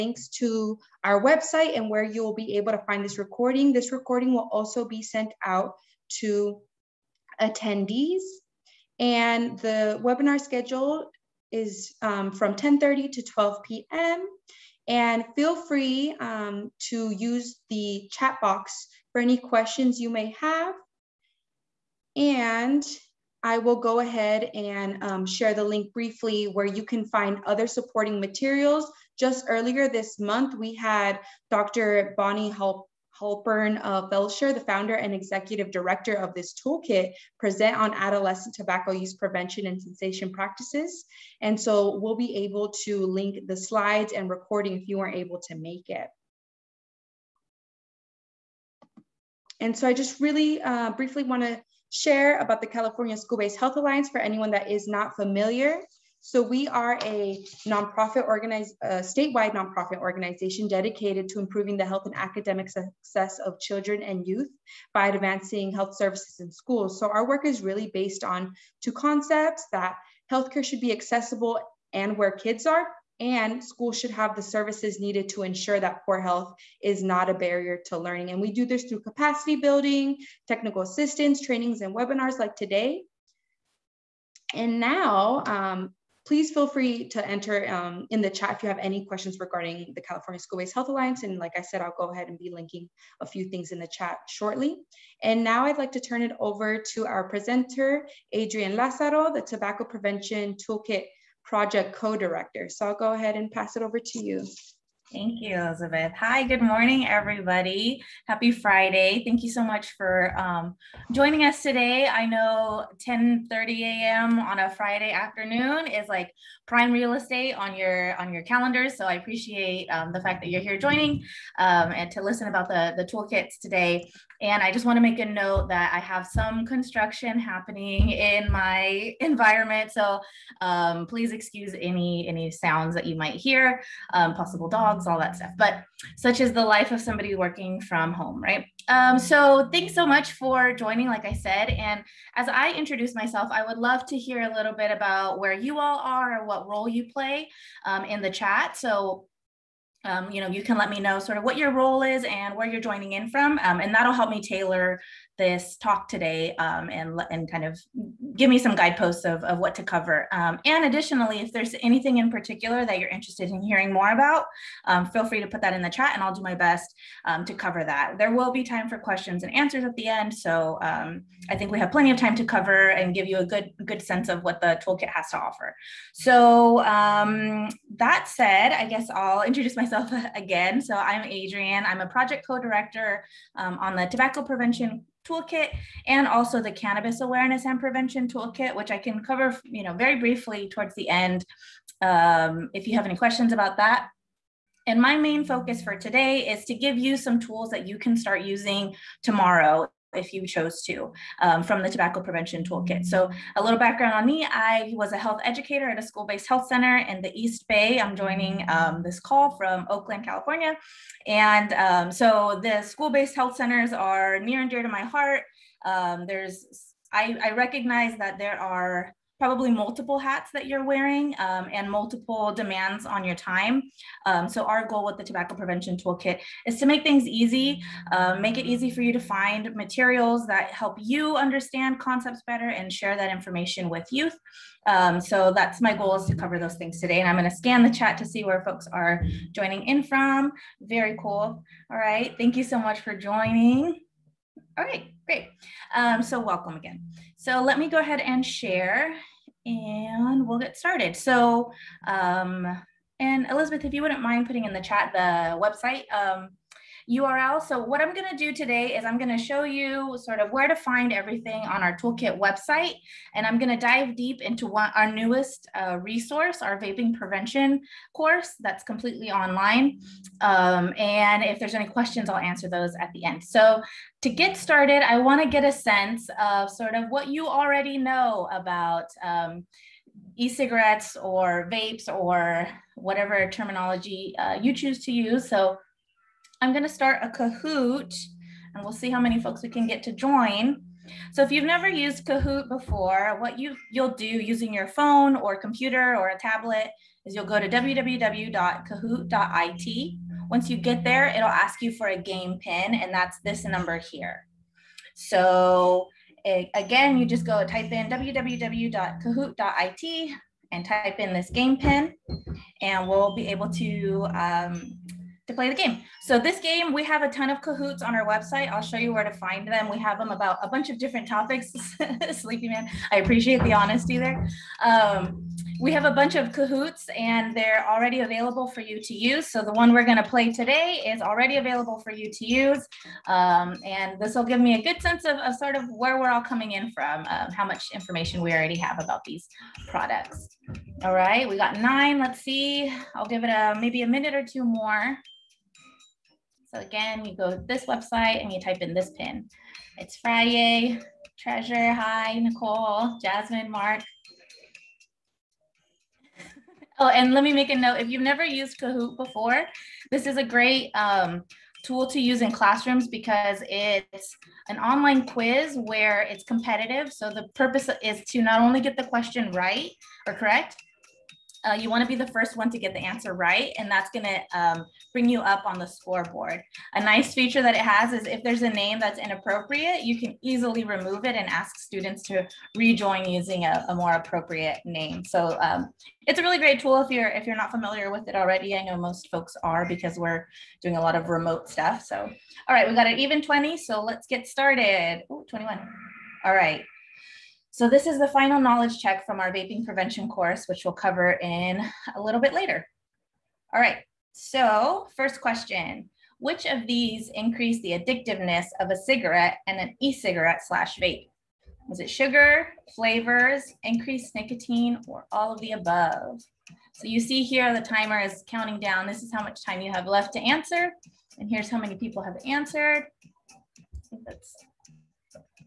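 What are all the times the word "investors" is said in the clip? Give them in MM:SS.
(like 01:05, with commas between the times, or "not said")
not said.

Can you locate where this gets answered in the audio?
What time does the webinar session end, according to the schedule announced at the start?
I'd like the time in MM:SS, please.
00:13.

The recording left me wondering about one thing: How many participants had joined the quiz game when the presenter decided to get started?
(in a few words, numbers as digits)
21.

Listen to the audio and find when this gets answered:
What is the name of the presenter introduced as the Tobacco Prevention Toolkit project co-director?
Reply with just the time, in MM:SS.
01:38.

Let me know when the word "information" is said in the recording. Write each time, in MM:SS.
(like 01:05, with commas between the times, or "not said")
03:53, 05:37.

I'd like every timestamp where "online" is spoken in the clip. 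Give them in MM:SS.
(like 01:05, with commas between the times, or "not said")
04:29, 06:04.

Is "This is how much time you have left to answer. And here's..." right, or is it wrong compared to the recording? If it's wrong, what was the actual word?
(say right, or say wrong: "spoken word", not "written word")
right.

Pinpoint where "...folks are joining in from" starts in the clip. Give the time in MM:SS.
03:58.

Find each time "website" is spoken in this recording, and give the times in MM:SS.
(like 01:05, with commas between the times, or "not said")
00:01, 04:15, 04:22, 05:18, 05:47.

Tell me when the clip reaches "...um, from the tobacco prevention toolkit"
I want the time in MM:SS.
03:21.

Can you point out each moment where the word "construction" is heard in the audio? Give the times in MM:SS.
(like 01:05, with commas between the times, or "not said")
02:06.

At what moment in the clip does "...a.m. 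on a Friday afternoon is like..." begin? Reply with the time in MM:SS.
01:53.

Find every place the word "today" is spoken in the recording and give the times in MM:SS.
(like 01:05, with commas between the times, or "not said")
01:22, 01:51, 02:03, 02:36, 03:15, 03:56, 04:18, 05:30.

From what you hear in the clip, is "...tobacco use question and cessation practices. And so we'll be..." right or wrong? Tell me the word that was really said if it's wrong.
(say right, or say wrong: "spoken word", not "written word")
wrong: "prevention", not "question".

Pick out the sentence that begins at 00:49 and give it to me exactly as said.
And so I just really uh, briefly want to share about the California School-Based Health Alliance for anyone that is not familiar.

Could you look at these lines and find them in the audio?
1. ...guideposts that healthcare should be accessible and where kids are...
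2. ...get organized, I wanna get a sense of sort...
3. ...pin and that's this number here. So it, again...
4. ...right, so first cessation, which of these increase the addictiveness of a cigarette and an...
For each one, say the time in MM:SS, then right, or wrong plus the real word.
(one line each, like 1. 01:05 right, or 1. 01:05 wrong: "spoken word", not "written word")
1. 01:08 wrong: "concepts", not "guideposts"
2. 04:34 wrong: "started", not "organized"
3. 05:02 right
4. 06:43 wrong: "question", not "cessation".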